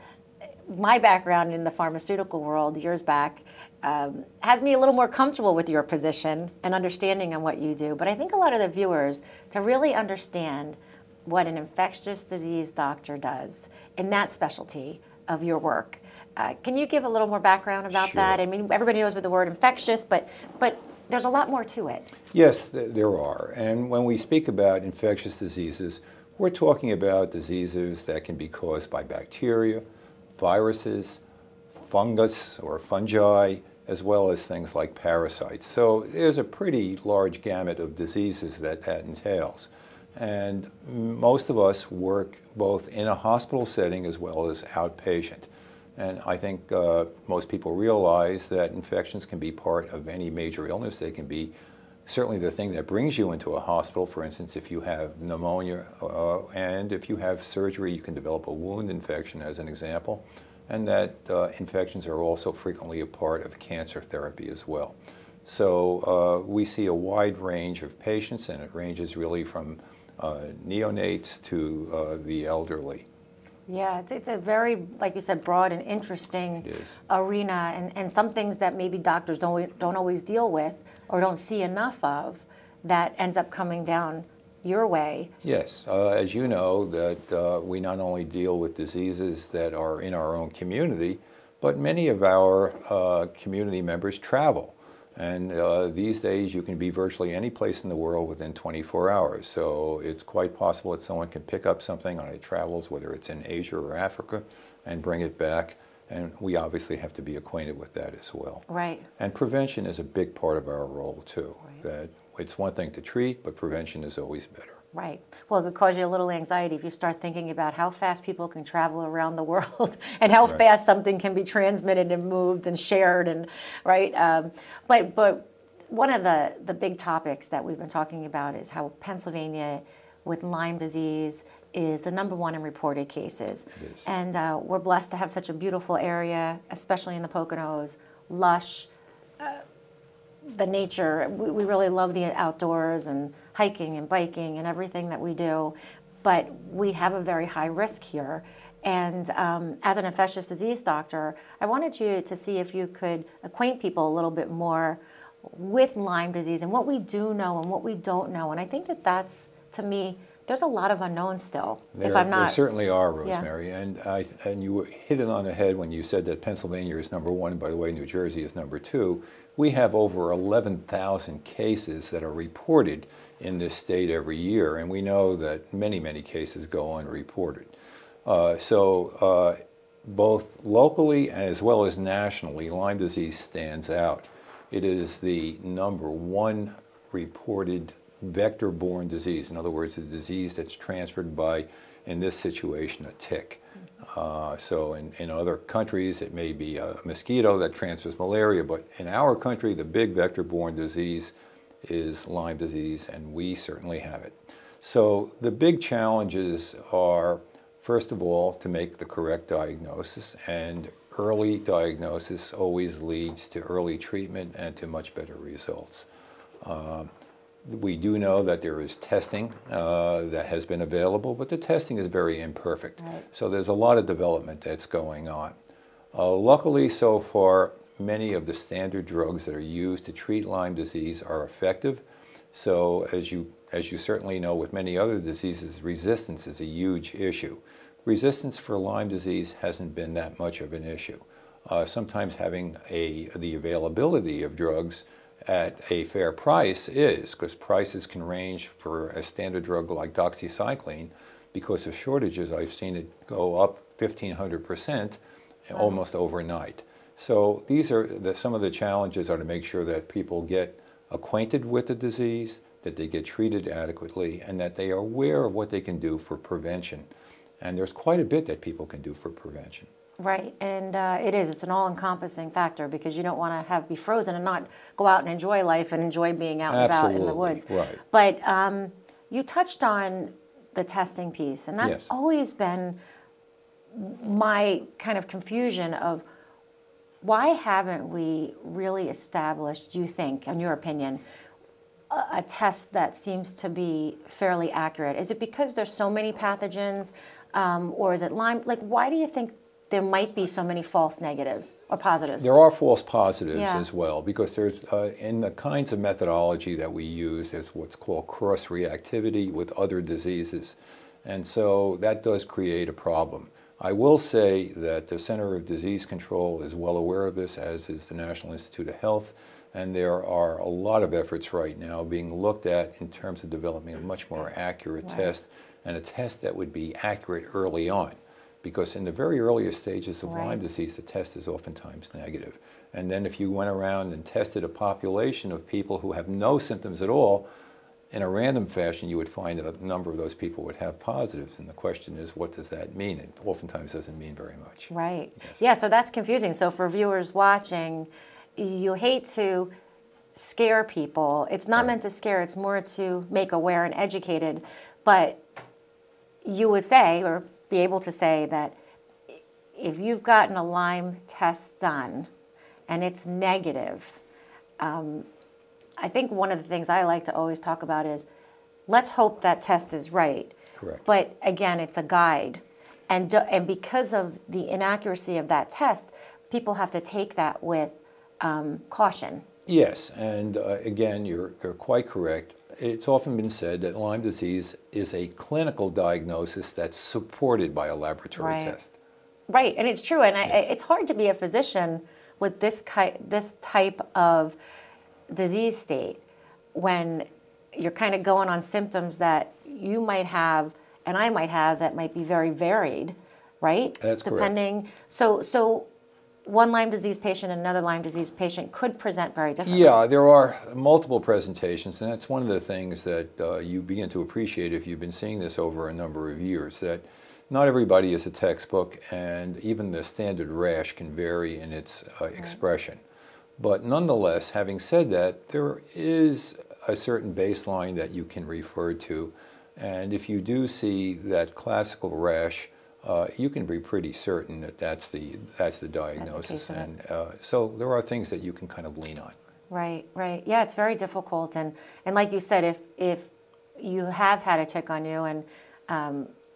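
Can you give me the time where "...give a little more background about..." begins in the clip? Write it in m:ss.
0:16.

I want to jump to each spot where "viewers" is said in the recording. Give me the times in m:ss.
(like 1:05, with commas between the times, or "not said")
0:08, 5:46.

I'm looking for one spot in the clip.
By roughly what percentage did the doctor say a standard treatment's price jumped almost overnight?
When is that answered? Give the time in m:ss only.
4:13.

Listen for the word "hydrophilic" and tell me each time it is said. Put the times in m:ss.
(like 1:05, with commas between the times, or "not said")
not said.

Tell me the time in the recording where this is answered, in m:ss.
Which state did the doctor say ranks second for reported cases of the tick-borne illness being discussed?
2:47.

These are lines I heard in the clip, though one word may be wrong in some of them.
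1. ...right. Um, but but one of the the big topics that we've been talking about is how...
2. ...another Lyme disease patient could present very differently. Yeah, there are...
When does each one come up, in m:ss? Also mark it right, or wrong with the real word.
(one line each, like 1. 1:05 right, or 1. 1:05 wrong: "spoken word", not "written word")
1. 2:03 right
2. 6:47 right.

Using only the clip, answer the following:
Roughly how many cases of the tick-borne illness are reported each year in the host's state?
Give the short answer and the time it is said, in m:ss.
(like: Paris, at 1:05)
11,000, at 2:50.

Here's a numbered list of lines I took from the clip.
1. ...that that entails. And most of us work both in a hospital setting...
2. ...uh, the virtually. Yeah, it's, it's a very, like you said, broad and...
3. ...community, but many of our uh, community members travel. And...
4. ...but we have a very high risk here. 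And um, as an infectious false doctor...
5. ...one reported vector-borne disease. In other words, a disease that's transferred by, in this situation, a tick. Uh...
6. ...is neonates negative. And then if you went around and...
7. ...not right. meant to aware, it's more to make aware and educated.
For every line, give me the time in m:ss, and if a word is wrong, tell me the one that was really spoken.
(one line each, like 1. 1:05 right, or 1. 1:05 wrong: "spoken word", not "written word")
1. 0:38 right
2. 1:11 wrong: "elderly", not "virtually"
3. 1:30 right
4. 2:26 wrong: "disease", not "false"
5. 3:06 right
6. 5:31 wrong: "oftentimes", not "neonates"
7. 5:51 wrong: "scare", not "aware".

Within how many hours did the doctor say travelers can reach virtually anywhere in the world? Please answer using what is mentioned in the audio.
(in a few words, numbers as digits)
24.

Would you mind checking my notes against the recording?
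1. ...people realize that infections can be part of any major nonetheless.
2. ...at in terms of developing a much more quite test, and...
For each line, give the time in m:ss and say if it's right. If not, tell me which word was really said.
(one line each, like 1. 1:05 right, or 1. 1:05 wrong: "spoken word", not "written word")
1. 0:47 wrong: "illness", not "nonetheless"
2. 5:22 wrong: "accurate", not "quite".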